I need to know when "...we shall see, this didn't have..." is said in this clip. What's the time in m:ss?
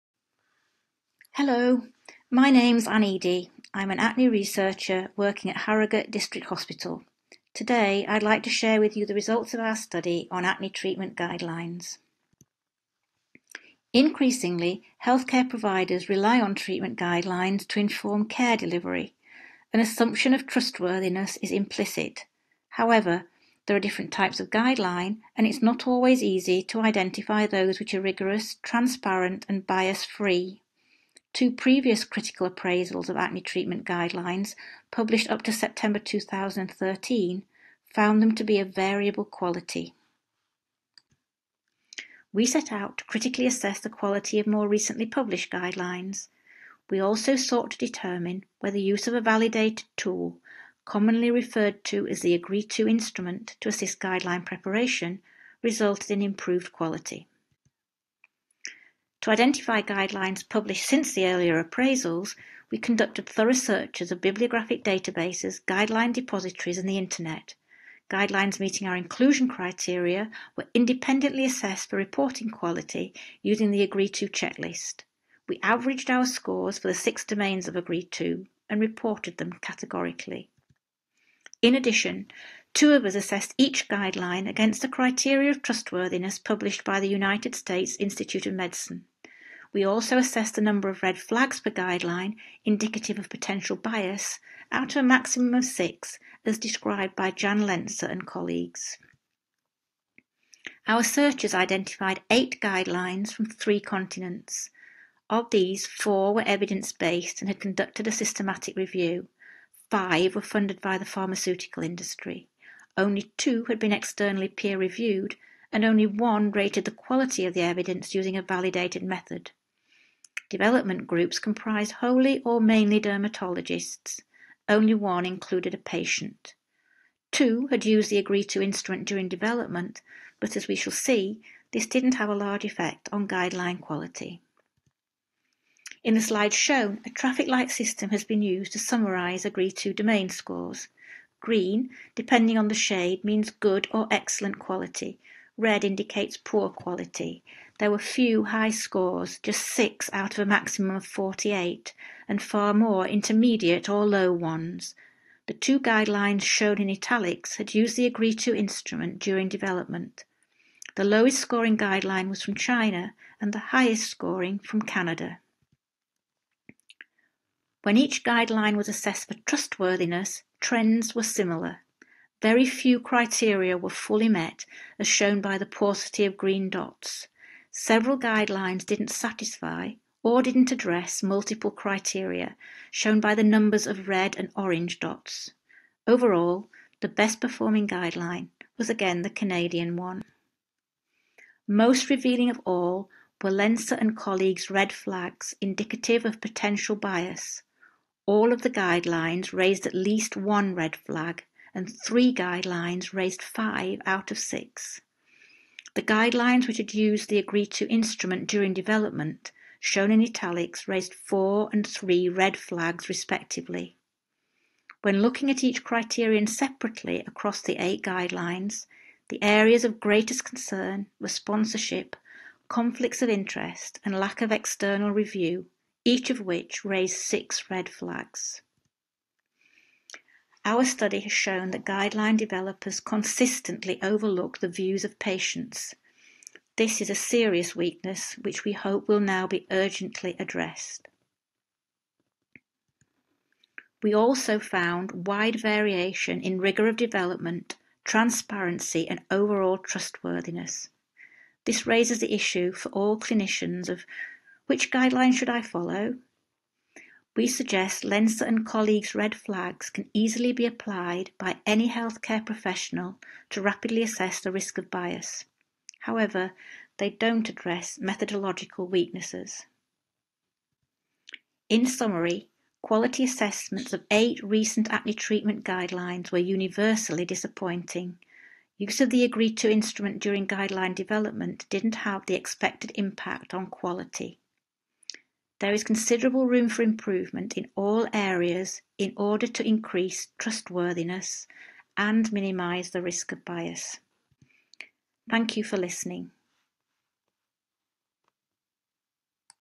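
2:10.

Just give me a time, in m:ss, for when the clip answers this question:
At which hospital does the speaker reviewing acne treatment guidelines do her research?
0:05.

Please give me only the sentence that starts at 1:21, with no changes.
In addition, Two of us assessed each guideline against the criteria of trustworthiness published by the United States Institute of Medicine.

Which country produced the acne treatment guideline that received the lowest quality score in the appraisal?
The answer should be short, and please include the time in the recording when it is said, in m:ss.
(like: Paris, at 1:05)
China, at 2:42.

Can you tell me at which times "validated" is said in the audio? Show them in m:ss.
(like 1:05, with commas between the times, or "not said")
0:49, 1:58.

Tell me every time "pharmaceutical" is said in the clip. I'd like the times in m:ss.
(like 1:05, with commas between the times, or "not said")
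1:51.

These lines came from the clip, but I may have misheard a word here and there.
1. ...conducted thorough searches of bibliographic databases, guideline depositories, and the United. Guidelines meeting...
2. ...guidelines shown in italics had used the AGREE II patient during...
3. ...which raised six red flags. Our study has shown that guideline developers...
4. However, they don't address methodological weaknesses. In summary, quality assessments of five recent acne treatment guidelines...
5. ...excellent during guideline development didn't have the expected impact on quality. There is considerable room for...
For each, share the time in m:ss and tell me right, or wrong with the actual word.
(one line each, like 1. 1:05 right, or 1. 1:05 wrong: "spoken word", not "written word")
1. 1:02 wrong: "Internet", not "United"
2. 2:35 wrong: "instrument", not "patient"
3. 3:46 right
4. 4:26 wrong: "eight", not "five"
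5. 4:39 wrong: "instrument", not "excellent".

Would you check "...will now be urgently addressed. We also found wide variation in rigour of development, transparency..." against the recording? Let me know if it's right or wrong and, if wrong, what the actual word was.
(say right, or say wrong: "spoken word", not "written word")
right.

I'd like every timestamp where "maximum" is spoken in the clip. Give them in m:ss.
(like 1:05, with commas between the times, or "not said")
1:35, 2:30.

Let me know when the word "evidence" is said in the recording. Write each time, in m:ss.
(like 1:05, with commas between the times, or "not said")
1:46, 1:57.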